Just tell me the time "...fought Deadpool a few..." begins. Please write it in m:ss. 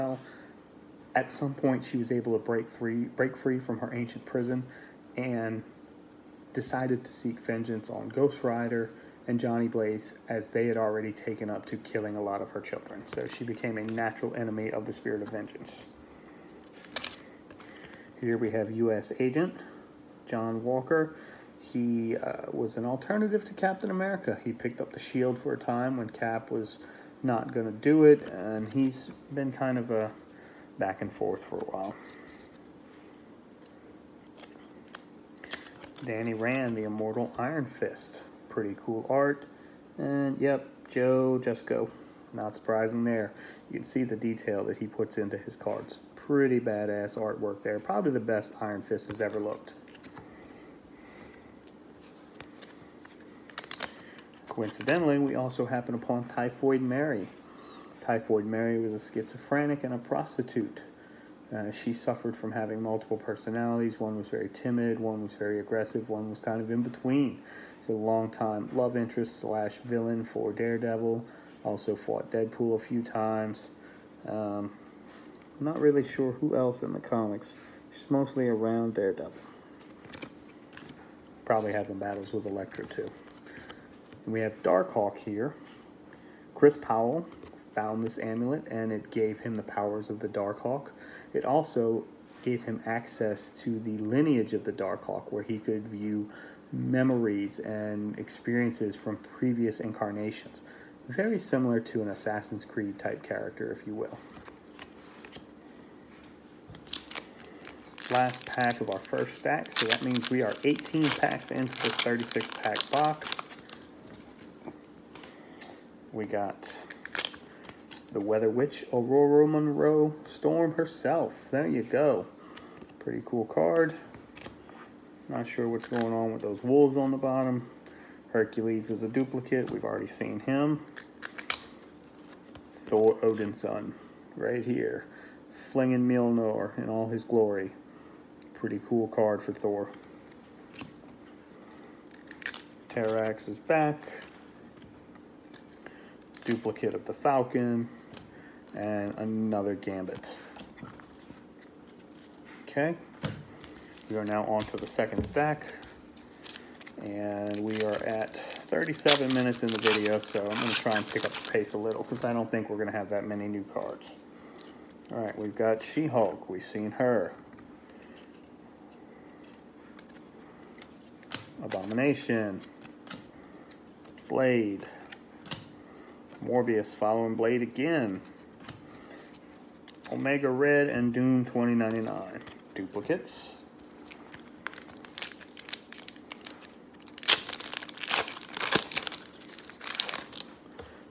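1:11.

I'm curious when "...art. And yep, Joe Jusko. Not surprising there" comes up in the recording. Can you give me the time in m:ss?
0:39.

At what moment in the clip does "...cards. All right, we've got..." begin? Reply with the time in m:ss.
2:43.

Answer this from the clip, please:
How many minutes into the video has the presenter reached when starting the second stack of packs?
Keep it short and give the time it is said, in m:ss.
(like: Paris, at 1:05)
37, at 2:38.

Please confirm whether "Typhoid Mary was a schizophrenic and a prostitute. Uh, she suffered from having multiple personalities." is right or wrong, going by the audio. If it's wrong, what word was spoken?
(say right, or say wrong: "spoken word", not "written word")
right.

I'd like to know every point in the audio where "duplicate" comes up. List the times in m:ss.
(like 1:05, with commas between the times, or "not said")
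2:09, 2:26, 3:02.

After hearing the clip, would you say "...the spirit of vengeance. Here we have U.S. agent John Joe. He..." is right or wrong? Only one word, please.
wrong.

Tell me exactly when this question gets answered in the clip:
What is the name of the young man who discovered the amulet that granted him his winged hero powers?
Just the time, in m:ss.
1:26.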